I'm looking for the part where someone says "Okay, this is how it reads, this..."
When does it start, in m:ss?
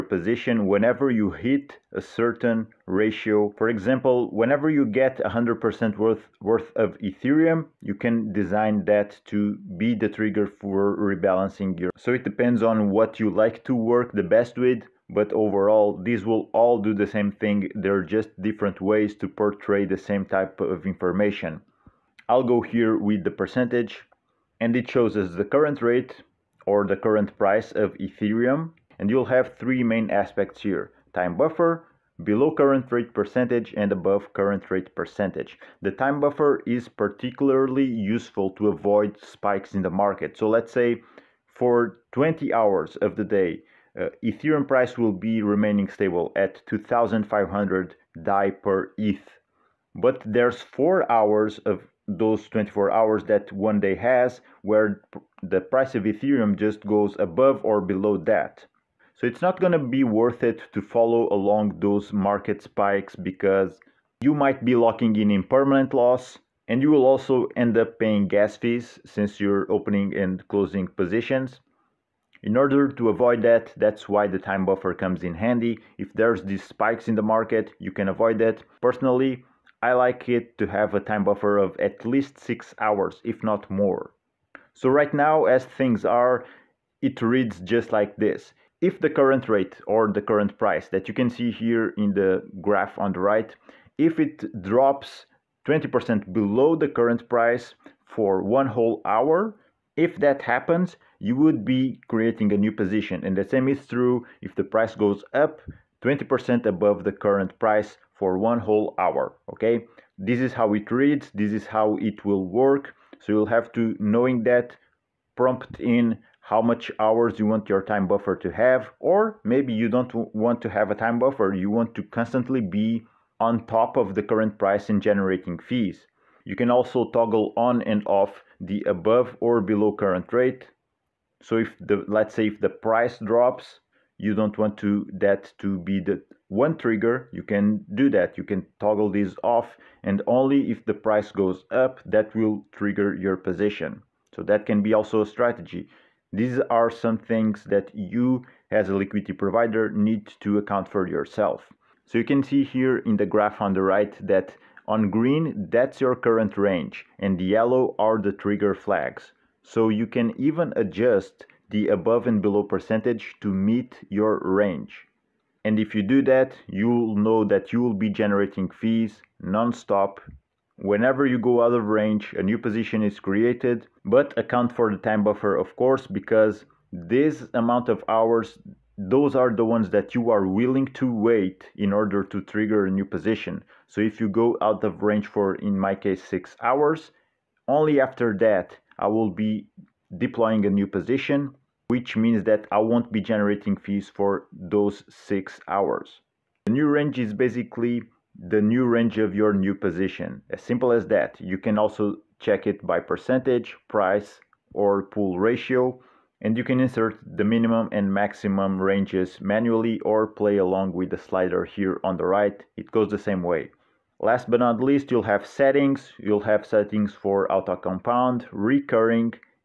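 1:49.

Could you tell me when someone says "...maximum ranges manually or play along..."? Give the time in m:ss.
3:28.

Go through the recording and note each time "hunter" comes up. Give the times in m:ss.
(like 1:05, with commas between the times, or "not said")
not said.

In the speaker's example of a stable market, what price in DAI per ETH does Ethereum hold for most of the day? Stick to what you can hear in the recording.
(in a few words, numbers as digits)
2,500.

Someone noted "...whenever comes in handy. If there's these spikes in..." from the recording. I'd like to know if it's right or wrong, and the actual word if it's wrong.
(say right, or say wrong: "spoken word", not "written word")
wrong: "buffer", not "whenever".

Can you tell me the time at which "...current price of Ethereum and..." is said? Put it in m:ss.
0:26.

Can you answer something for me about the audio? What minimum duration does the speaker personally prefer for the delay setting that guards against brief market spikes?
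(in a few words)
6 hours.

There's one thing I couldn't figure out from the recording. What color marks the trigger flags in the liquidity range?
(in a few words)
yellow.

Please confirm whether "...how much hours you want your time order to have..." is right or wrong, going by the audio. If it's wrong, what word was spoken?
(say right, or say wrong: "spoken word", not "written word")
wrong: "buffer", not "order".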